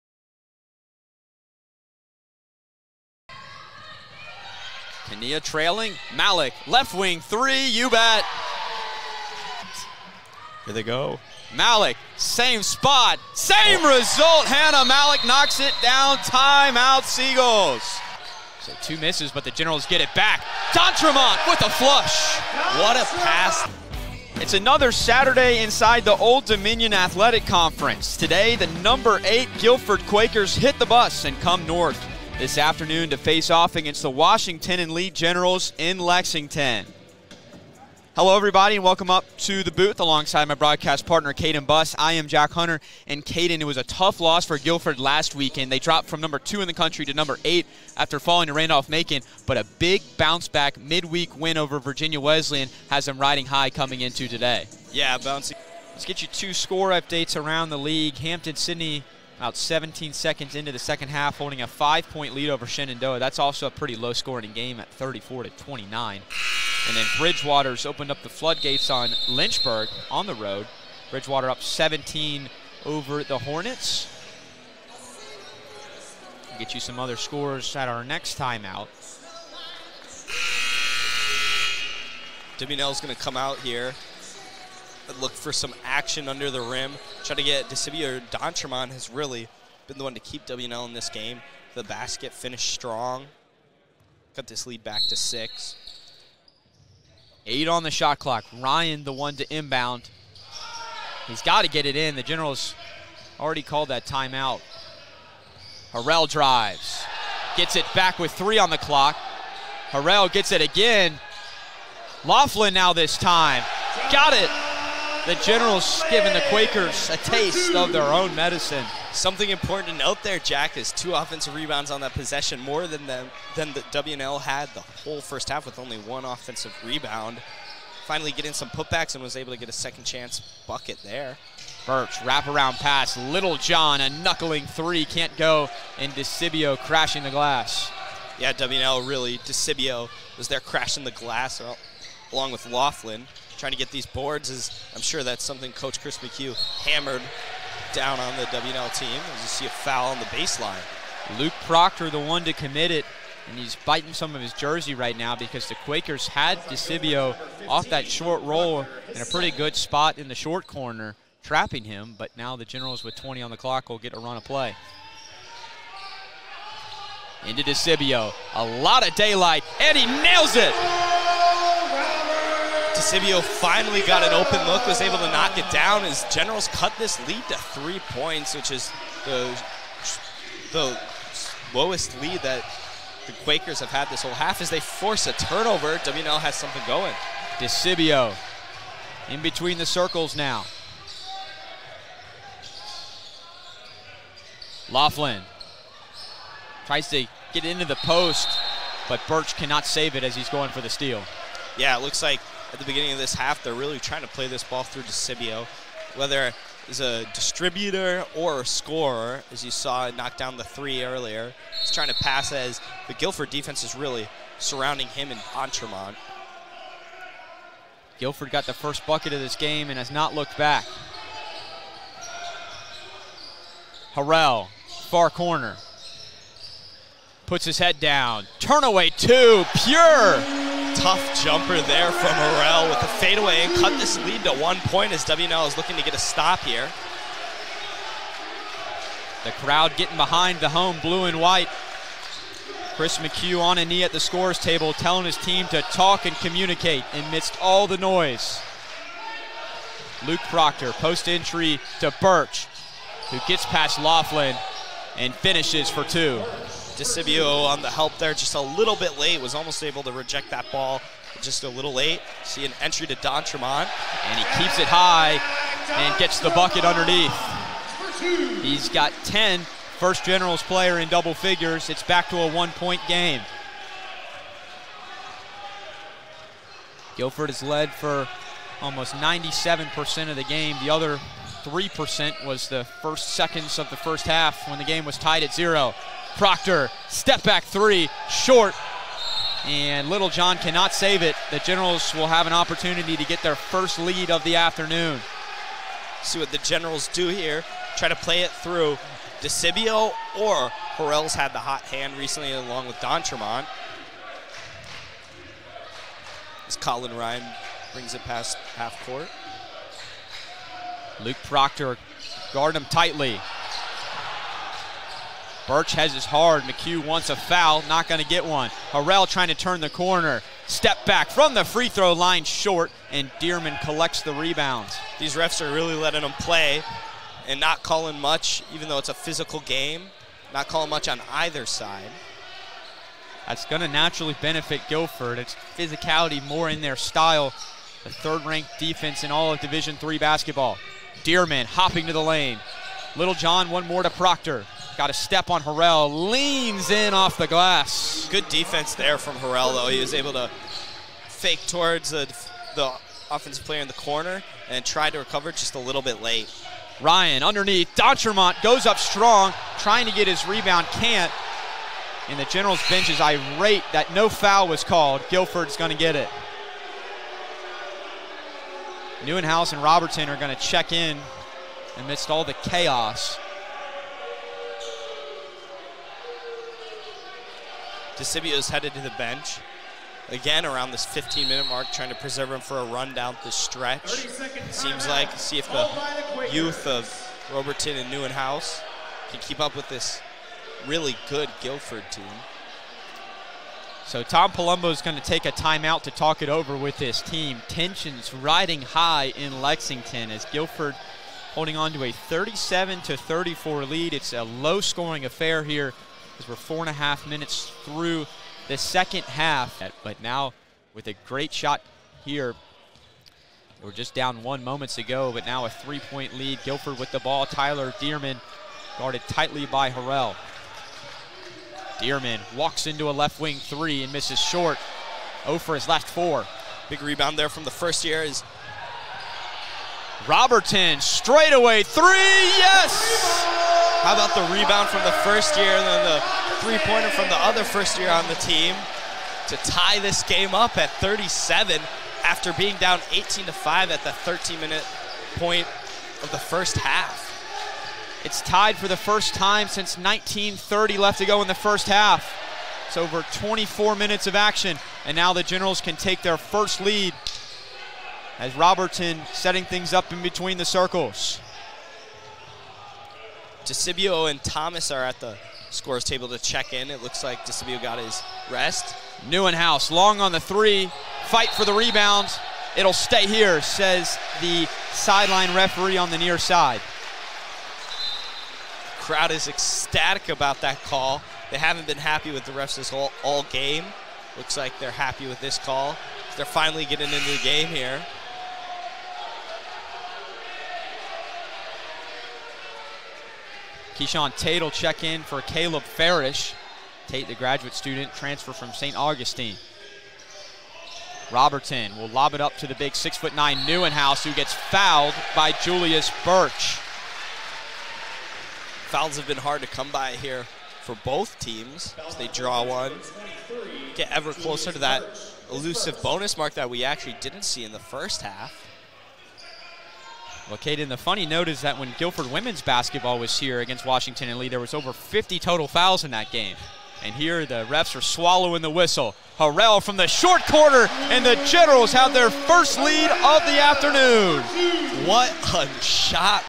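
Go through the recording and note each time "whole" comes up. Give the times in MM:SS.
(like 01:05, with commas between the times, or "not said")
02:04, 03:04, 08:02.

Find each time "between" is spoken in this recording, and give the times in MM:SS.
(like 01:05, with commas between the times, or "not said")
03:09, 07:40.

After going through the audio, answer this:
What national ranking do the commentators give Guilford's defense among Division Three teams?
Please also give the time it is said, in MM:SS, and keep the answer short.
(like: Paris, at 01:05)
third-ranked, at 05:38.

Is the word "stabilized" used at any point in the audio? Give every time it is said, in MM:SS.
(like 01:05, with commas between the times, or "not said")
not said.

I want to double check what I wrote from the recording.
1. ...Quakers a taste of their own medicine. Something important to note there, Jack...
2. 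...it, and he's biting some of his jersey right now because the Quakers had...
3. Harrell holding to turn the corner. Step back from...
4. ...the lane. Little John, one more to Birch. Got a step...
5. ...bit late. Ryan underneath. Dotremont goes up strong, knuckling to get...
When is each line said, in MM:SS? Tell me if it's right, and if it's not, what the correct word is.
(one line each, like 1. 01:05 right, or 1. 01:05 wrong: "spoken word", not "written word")
1. 01:56 right
2. 02:32 right
3. 05:18 wrong: "trying", not "holding"
4. 05:42 wrong: "Proctor", not "Birch"
5. 05:56 wrong: "trying", not "knuckling".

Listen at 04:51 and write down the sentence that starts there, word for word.
The Generals will have an opportunity to get their first lead of the afternoon.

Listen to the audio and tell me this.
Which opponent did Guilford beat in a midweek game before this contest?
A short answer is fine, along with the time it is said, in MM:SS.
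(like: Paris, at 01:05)
Virginia Wesleyan, at 00:51.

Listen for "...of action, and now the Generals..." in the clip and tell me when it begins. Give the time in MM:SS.
07:34.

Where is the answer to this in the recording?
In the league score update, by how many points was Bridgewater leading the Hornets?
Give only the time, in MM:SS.
01:11.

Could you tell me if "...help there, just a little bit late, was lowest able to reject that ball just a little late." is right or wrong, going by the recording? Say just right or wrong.
wrong.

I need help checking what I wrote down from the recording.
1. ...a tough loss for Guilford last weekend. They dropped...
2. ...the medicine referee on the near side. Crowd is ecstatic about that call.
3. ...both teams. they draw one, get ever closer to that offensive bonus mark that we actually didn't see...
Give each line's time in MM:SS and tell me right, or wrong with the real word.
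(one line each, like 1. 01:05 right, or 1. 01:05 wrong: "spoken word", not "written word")
1. 00:43 right
2. 07:54 wrong: "sideline", not "medicine"
3. 08:31 wrong: "elusive", not "offensive".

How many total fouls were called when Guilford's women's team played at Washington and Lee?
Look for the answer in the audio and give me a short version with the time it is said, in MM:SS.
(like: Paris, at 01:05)
over 50, at 08:44.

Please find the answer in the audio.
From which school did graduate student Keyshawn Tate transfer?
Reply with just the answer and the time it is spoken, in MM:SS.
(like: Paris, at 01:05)
St. Augustine, at 08:18.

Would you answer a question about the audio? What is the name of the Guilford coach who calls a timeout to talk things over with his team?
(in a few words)
Tom Palumbo.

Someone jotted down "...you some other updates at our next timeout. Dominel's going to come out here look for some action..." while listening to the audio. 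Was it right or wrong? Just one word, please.
wrong.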